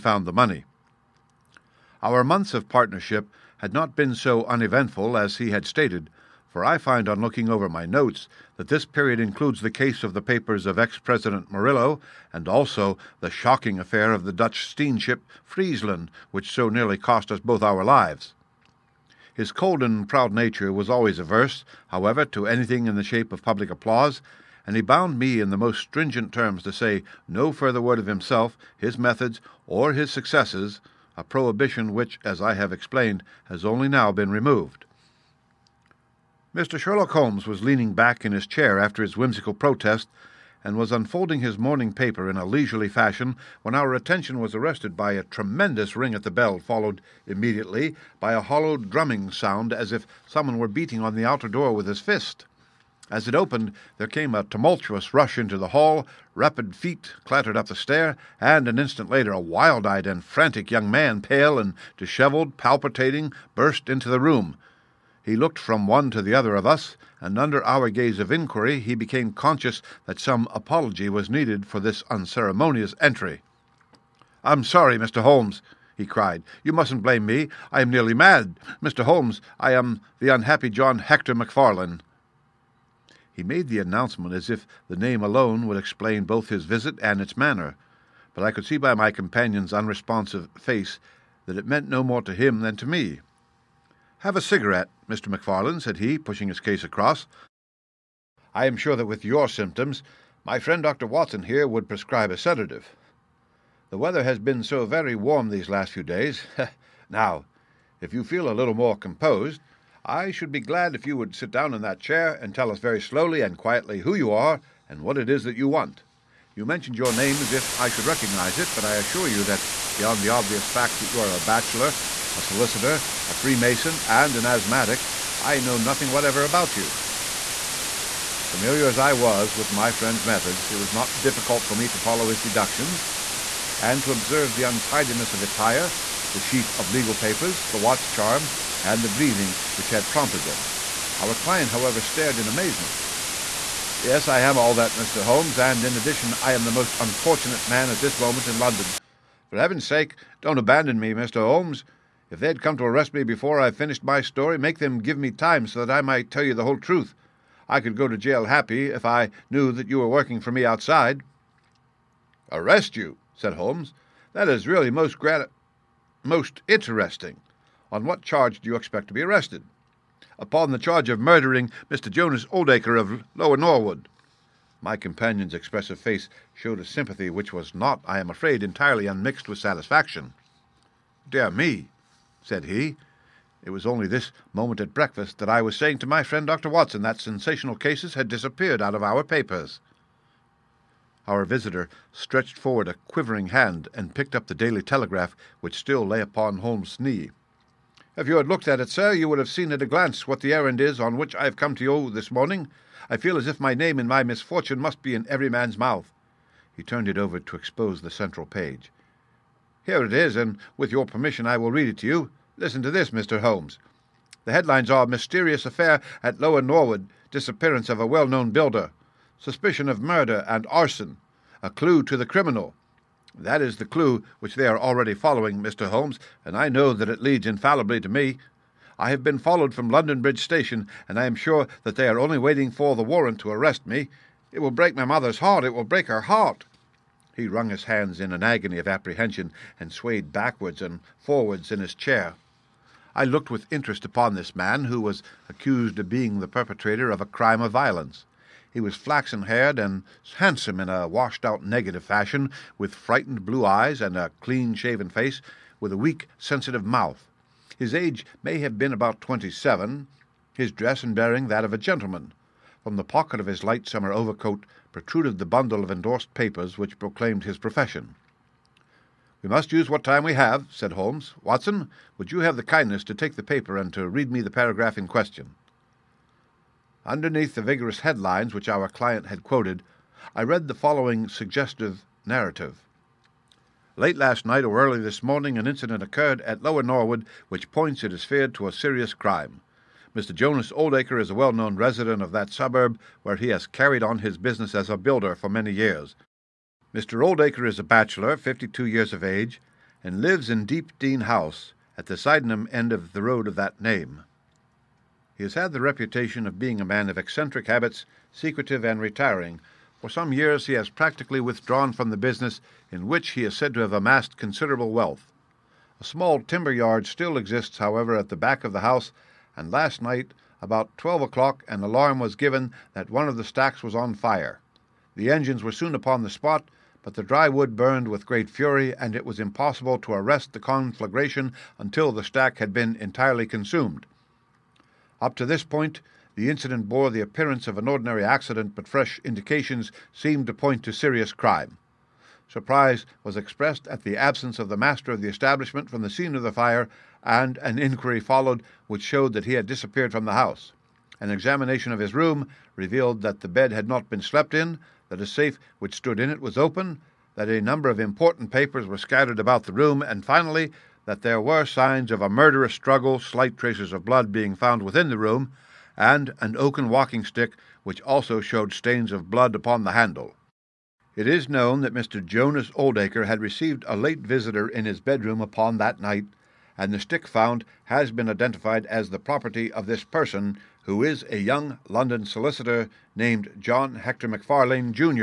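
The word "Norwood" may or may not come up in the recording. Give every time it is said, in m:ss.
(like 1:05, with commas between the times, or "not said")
2:53, 3:36, 4:46.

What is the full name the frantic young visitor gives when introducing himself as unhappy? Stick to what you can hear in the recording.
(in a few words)
John Hector MacFarlane.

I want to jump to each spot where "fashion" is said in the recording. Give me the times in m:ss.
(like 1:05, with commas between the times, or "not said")
0:42, 4:12.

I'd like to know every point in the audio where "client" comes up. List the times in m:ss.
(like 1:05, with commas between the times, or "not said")
2:21, 4:38.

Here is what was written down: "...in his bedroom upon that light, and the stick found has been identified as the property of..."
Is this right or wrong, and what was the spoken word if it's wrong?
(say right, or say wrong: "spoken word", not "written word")
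wrong: "night", not "light".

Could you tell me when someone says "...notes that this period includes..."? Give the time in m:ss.
0:07.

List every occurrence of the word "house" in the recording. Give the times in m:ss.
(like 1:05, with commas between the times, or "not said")
5:01, 5:18, 5:50.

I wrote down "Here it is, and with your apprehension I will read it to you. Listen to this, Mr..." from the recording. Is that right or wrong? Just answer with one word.
wrong.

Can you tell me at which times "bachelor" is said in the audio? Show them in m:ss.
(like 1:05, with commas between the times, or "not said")
2:01, 4:57.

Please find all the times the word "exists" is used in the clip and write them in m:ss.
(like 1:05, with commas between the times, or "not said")
5:17.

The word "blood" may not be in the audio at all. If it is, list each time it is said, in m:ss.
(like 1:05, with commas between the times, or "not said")
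6:04, 6:09.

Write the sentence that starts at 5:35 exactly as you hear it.
Up to this point, the incident bore the appearance of an ordinary accident, but fresh indications seemed to point to serious crime.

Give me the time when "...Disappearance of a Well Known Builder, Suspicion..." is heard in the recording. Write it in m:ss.
3:37.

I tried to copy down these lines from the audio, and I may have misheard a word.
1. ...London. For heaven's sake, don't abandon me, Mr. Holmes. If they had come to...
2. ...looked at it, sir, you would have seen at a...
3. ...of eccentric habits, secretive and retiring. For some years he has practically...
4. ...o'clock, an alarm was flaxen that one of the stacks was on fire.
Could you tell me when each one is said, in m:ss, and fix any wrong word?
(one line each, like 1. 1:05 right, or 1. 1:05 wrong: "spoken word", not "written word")
1. 2:28 right
2. 3:18 right
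3. 5:07 right
4. 5:21 wrong: "given", not "flaxen".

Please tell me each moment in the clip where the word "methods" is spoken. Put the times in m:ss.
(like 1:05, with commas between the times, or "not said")
0:28, 2:10.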